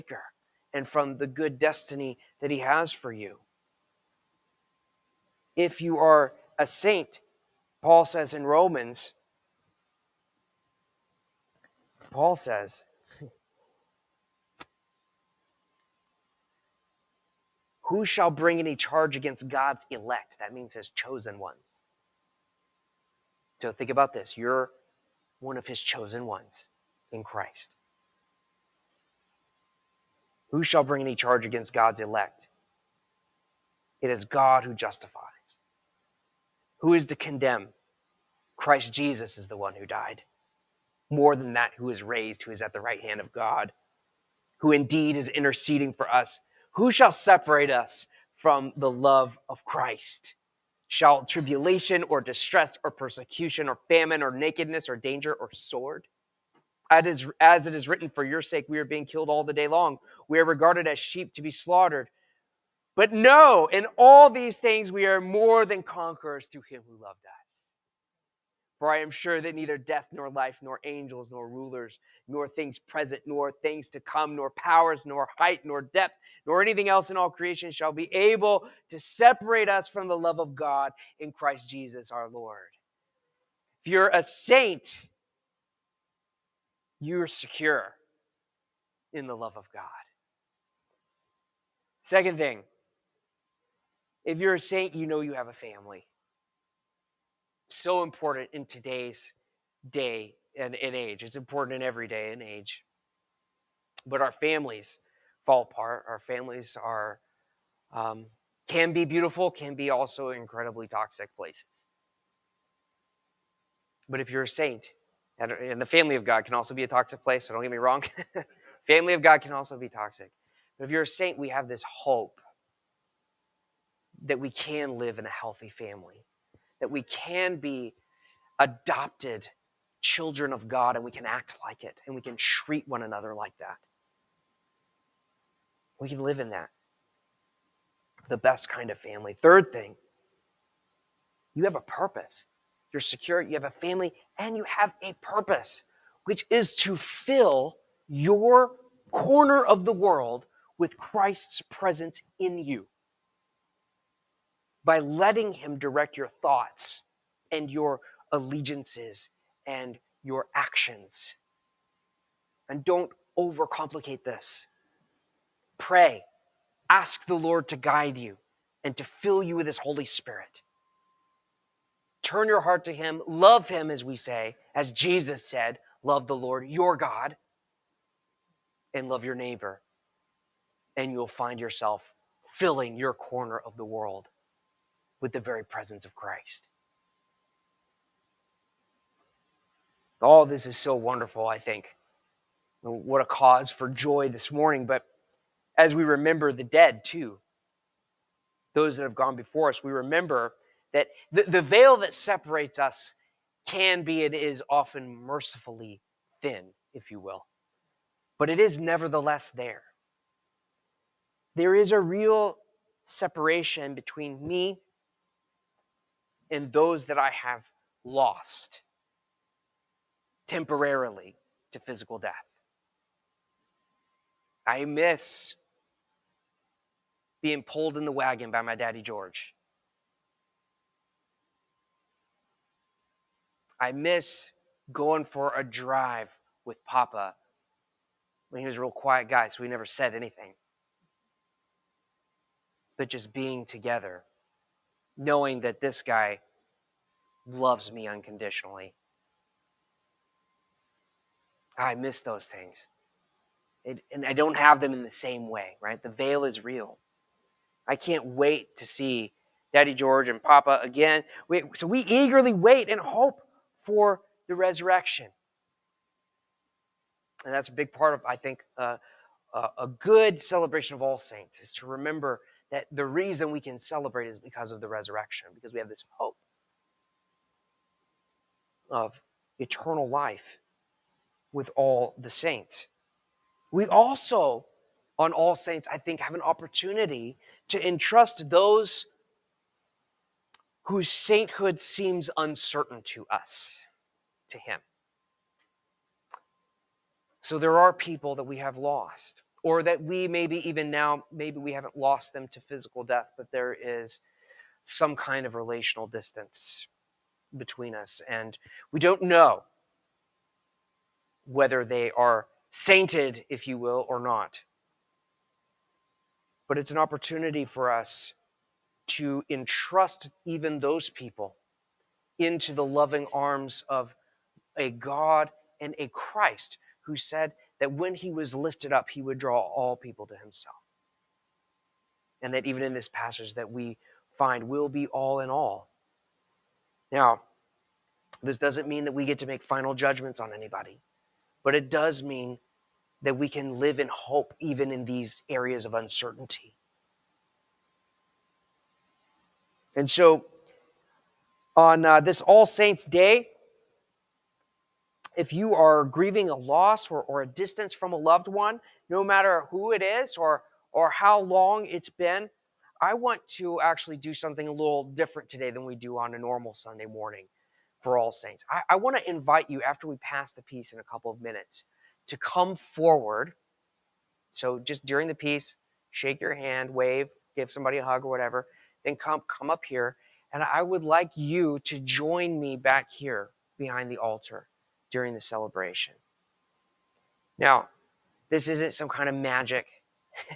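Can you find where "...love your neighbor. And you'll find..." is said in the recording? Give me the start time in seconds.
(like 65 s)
179 s.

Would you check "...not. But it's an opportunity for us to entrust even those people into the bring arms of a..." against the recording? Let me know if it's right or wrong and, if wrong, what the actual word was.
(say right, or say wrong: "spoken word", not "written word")
wrong: "loving", not "bring".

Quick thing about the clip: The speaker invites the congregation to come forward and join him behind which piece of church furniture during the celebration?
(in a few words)
the altar.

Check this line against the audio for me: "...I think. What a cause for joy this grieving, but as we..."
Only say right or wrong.
wrong.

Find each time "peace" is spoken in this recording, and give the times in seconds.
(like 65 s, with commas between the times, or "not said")
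370 s, 375 s.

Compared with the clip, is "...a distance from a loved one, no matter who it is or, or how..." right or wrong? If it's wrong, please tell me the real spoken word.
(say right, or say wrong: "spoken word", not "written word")
right.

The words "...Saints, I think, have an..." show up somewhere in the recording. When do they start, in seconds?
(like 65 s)
285 s.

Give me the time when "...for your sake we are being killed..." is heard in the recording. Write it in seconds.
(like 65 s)
58 s.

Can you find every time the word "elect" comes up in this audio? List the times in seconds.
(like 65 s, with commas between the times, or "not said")
19 s, 32 s.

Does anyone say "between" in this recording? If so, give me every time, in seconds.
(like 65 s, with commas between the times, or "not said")
213 s, 307 s.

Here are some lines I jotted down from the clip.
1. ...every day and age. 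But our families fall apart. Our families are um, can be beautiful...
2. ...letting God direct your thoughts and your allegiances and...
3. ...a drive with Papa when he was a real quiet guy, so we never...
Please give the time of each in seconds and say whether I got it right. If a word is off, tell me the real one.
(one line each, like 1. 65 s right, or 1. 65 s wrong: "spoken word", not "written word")
1. 101 s right
2. 154 s wrong: "Him", not "God"
3. 235 s right.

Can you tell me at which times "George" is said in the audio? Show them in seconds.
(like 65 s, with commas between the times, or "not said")
229 s, 259 s.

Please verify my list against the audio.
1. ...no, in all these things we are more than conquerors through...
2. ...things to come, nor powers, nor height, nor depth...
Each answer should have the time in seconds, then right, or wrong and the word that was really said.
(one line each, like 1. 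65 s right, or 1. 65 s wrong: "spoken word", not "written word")
1. 63 s right
2. 73 s right.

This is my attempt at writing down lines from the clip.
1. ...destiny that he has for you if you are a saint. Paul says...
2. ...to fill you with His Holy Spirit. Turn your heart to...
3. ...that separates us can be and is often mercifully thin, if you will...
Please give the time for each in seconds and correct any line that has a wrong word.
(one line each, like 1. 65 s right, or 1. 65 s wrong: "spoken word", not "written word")
1. 1 s right
2. 168 s right
3. 201 s right.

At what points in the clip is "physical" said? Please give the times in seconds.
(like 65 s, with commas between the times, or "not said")
221 s, 302 s.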